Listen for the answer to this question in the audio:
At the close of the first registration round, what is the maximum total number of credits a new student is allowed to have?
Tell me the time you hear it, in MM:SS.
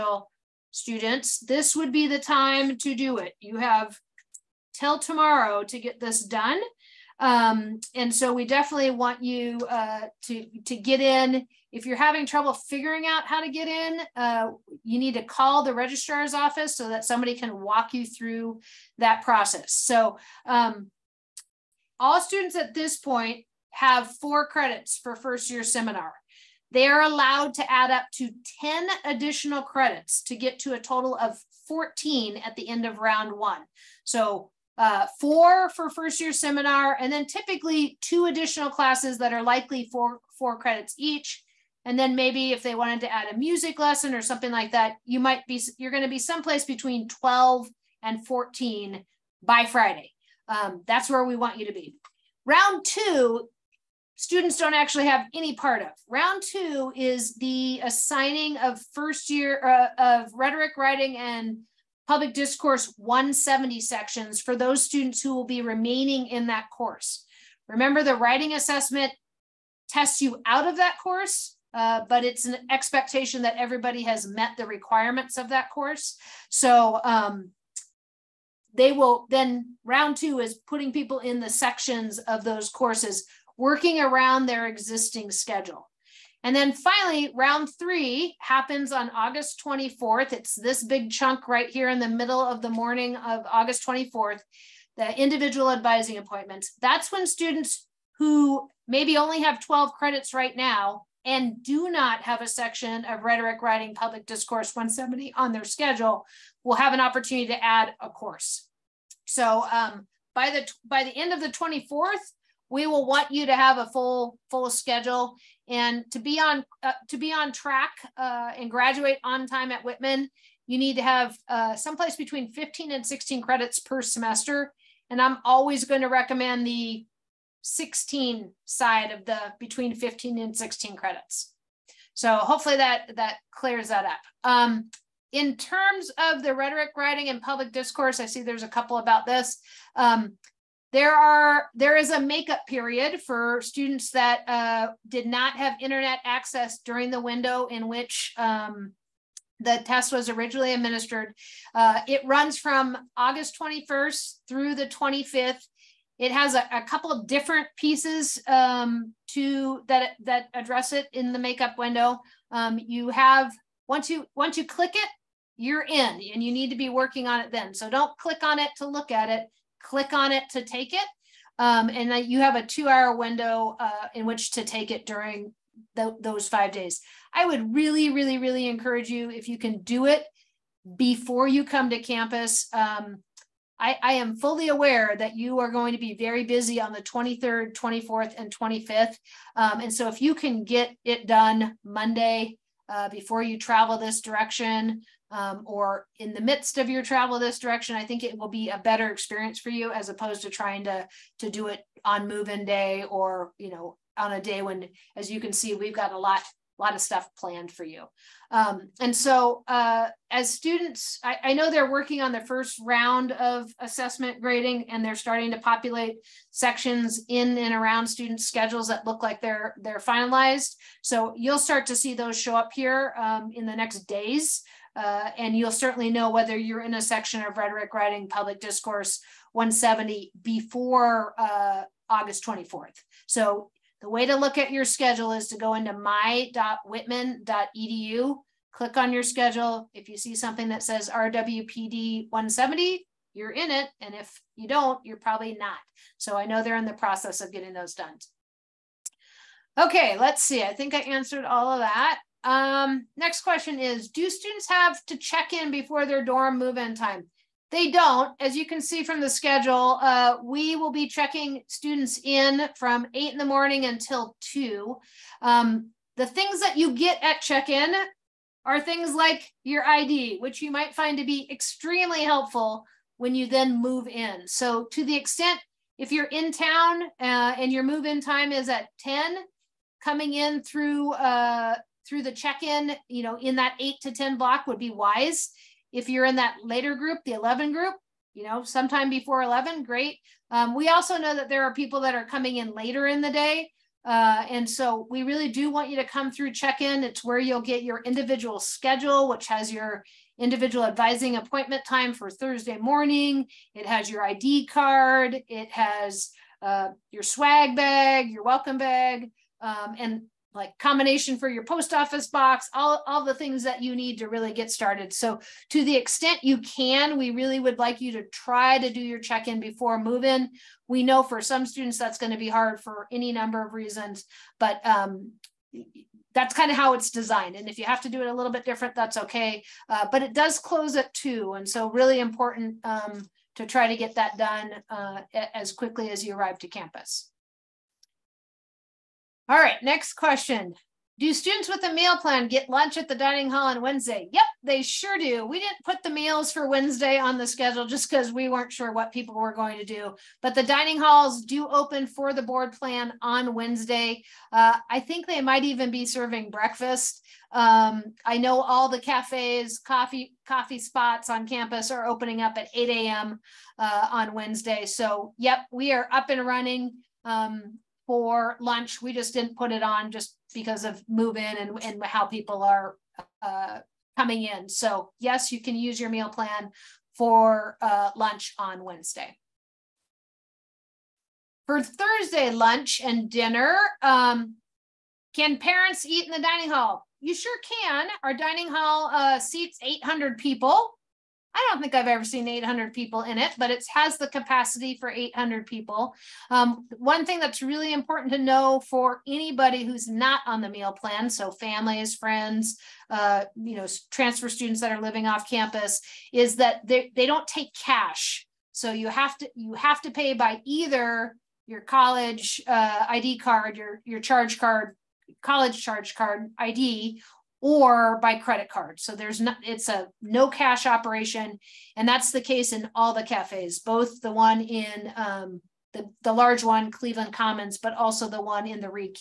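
00:30.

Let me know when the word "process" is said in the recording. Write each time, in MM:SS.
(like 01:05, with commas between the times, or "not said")
00:19, 04:06.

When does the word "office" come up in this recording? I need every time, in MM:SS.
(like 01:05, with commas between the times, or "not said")
00:16, 05:11.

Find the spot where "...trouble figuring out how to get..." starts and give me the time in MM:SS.
00:12.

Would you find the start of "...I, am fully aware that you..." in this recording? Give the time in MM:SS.
03:04.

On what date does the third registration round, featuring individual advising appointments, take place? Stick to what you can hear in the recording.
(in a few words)
August 24th.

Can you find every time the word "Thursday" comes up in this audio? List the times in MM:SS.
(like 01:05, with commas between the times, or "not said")
05:02, 06:21.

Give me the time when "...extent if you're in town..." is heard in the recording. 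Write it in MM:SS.
04:35.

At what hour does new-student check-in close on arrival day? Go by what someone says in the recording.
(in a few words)
2.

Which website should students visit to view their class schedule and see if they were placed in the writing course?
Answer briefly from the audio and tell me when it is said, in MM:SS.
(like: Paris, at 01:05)
my.whitman.edu, at 03:55.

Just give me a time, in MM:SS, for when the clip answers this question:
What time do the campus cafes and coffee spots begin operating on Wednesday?
06:02.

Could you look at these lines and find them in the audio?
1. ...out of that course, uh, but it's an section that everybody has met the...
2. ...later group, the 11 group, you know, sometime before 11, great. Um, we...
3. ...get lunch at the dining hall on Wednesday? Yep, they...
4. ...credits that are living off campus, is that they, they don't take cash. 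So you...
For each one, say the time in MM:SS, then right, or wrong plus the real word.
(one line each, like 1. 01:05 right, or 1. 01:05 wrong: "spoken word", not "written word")
1. 01:10 wrong: "expectation", not "section"
2. 04:46 right
3. 05:42 right
4. 06:44 wrong: "students", not "credits".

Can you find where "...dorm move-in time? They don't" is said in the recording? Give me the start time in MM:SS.
04:16.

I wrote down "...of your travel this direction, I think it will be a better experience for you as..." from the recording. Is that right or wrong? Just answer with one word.
right.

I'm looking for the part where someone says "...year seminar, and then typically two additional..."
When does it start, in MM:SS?
00:36.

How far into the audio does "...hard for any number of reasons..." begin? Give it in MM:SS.
05:22.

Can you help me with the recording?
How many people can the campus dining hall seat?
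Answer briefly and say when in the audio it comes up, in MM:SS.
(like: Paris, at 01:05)
800, at 06:29.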